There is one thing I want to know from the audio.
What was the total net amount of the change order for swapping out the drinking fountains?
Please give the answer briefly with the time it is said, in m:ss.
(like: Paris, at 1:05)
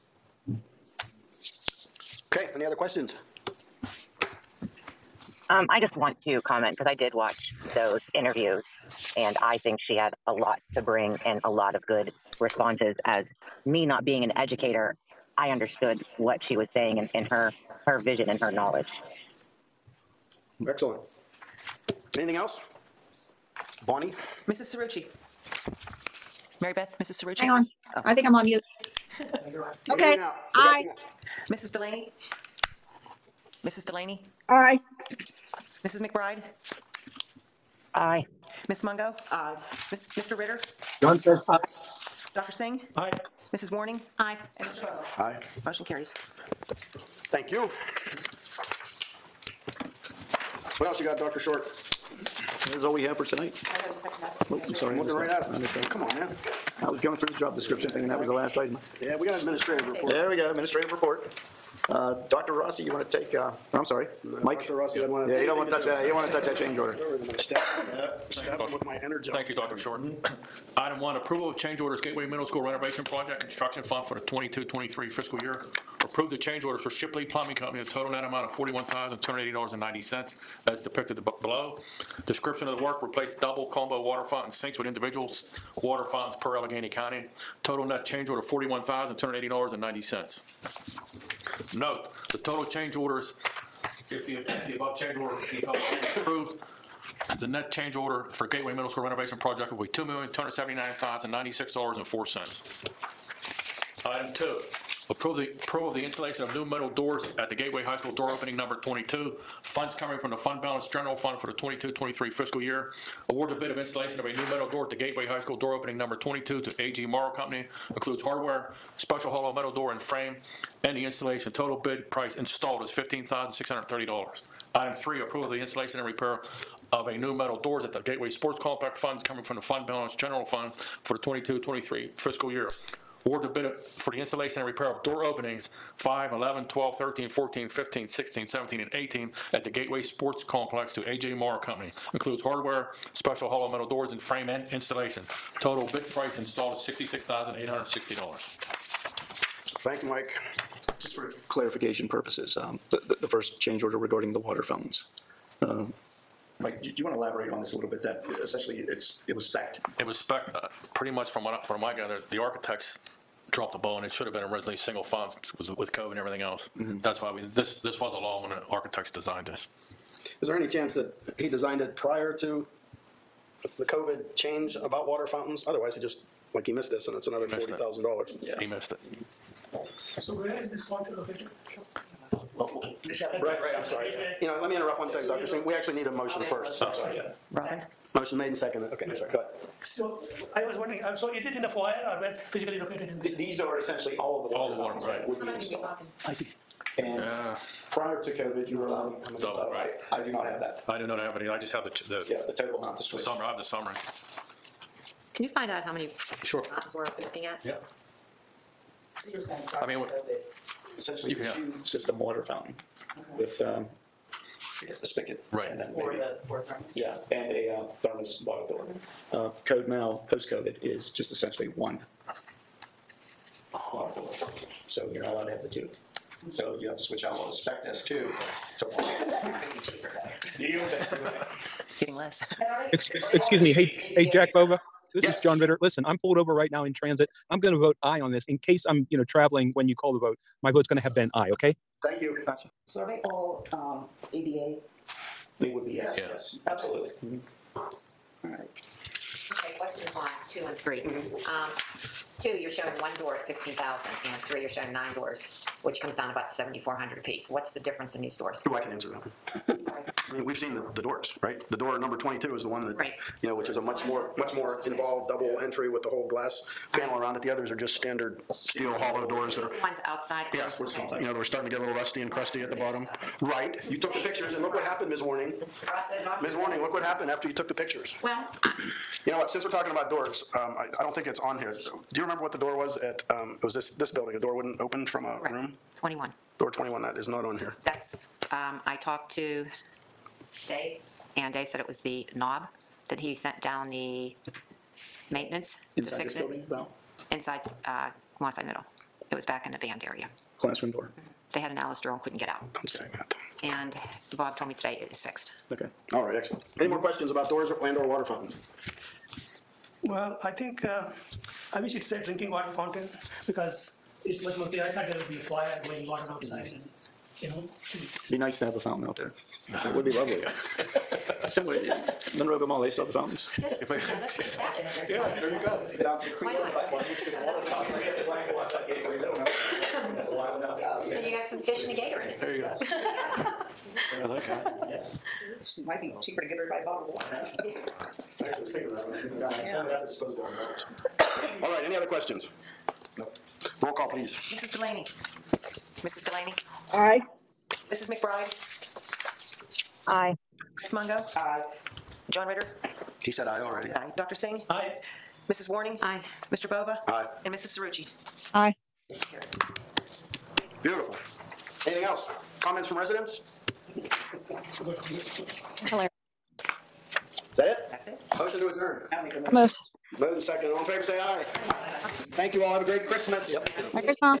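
$41,280.90, at 1:18.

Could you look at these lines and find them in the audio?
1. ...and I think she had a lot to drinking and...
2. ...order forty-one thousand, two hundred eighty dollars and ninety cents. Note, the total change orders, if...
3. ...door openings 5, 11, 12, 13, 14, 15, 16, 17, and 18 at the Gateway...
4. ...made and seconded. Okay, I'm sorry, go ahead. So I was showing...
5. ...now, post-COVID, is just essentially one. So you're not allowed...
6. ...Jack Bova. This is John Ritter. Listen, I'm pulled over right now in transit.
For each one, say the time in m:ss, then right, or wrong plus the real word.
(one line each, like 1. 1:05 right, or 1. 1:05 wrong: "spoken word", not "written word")
1. 0:09 wrong: "bring", not "drinking"
2. 1:28 right
3. 2:15 right
4. 3:08 wrong: "wondering", not "showing"
5. 3:39 right
6. 3:54 right.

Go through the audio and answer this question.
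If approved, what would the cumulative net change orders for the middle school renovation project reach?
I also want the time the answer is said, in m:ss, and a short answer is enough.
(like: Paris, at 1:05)
$2,279,096.04, at 1:39.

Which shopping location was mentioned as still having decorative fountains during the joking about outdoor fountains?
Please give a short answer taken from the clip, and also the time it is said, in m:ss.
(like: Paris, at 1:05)
Monroeville Mall, at 5:22.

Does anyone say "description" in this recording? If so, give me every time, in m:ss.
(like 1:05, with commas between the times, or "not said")
0:57, 1:22.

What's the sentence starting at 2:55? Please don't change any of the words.
Otherwise, he just, like, he missed this and it's another forty thousand it.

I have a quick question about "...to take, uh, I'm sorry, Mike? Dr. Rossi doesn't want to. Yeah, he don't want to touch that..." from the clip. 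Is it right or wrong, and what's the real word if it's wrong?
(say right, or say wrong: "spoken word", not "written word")
right.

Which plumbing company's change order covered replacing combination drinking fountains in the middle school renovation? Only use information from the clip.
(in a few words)
Shipley Plumbing Company.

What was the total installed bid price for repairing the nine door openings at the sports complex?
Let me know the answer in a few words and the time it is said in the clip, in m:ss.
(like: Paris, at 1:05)
$66,860, at 2:26.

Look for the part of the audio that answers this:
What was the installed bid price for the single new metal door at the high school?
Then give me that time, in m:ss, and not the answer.
2:02.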